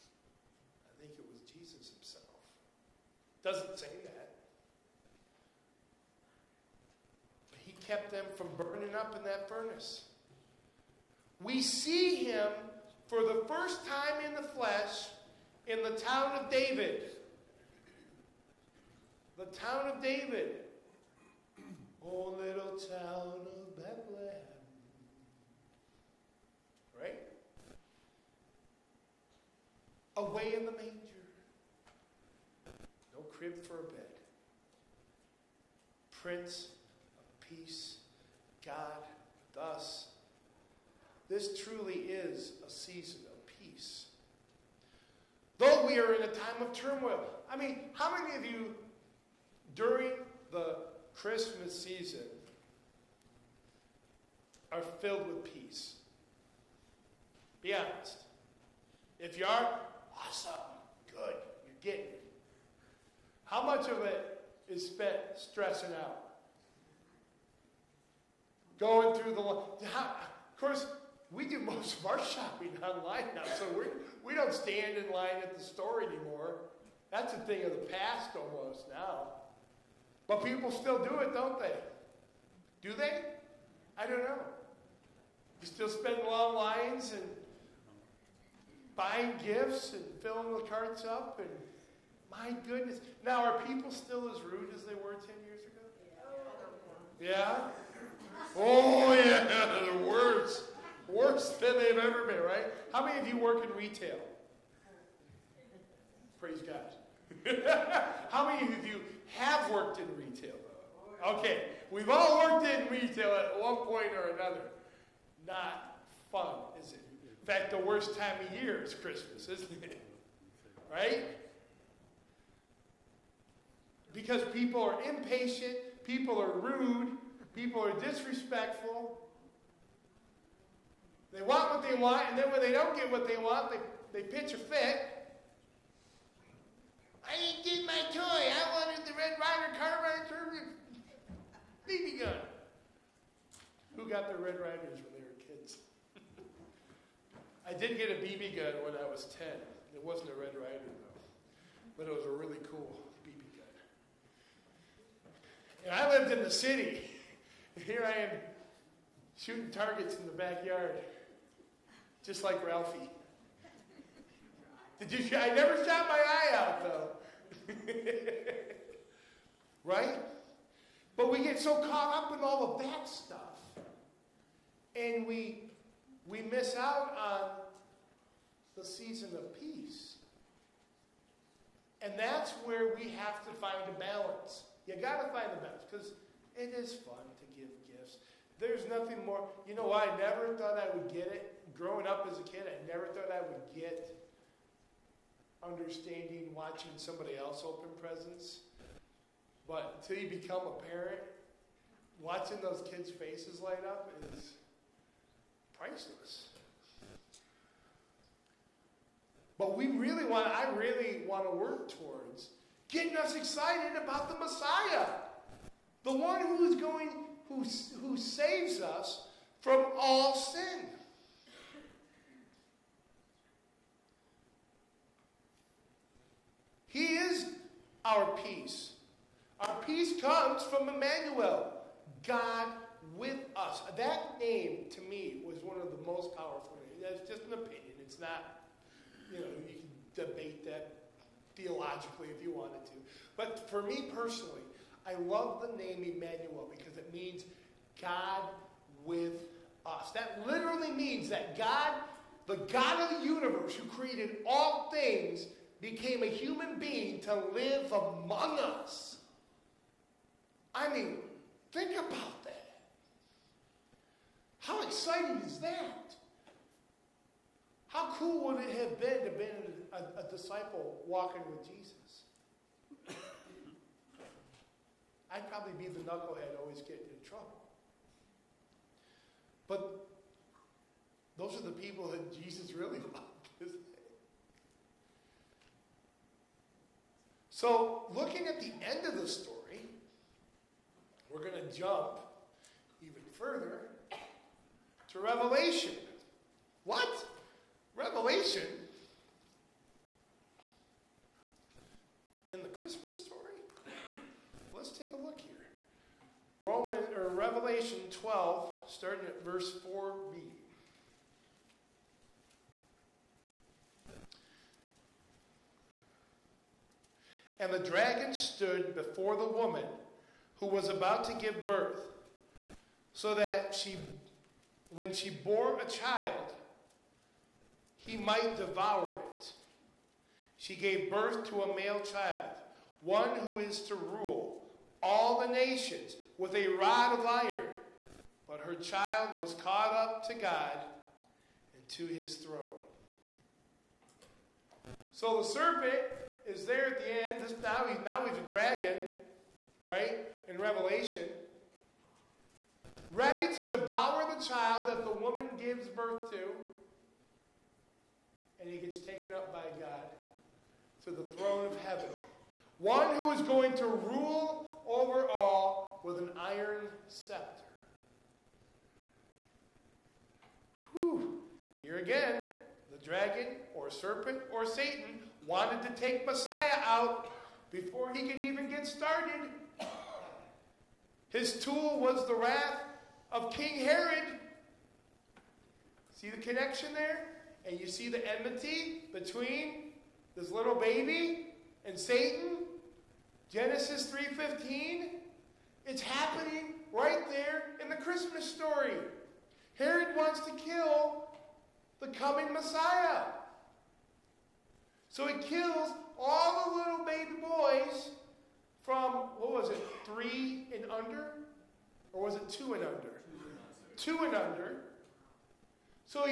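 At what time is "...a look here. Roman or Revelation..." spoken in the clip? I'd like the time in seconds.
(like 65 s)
305 s.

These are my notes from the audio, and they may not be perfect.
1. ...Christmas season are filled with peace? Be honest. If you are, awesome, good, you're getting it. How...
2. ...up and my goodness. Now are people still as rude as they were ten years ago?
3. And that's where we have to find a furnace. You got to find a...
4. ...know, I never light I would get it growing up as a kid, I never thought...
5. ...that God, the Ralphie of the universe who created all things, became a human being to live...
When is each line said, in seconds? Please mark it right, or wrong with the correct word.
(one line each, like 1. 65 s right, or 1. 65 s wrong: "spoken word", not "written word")
1. 51 s right
2. 91 s right
3. 182 s wrong: "balance", not "furnace"
4. 189 s wrong: "thought", not "light"
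5. 251 s wrong: "God", not "Ralphie".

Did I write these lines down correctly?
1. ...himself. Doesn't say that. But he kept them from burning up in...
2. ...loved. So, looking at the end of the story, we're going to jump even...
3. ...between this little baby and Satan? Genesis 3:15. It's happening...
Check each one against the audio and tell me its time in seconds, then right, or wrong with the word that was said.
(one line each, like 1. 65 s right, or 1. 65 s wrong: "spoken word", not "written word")
1. 1 s right
2. 283 s right
3. 389 s right.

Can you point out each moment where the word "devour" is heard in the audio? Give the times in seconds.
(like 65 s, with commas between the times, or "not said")
328 s, 353 s.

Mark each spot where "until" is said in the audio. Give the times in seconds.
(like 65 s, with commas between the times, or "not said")
200 s.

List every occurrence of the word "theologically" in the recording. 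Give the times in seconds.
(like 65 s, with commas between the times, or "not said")
241 s.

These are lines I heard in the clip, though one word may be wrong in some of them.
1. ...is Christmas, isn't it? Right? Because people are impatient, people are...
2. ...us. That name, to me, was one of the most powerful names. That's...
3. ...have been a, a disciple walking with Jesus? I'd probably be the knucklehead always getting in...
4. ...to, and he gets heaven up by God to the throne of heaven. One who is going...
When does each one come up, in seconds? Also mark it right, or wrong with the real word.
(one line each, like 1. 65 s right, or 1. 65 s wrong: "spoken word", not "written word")
1. 118 s right
2. 233 s right
3. 269 s right
4. 356 s wrong: "taken", not "heaven".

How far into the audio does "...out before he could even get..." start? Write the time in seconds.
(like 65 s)
376 s.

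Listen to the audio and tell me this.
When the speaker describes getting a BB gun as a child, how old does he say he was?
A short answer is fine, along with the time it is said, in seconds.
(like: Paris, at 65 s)
10, at 149 s.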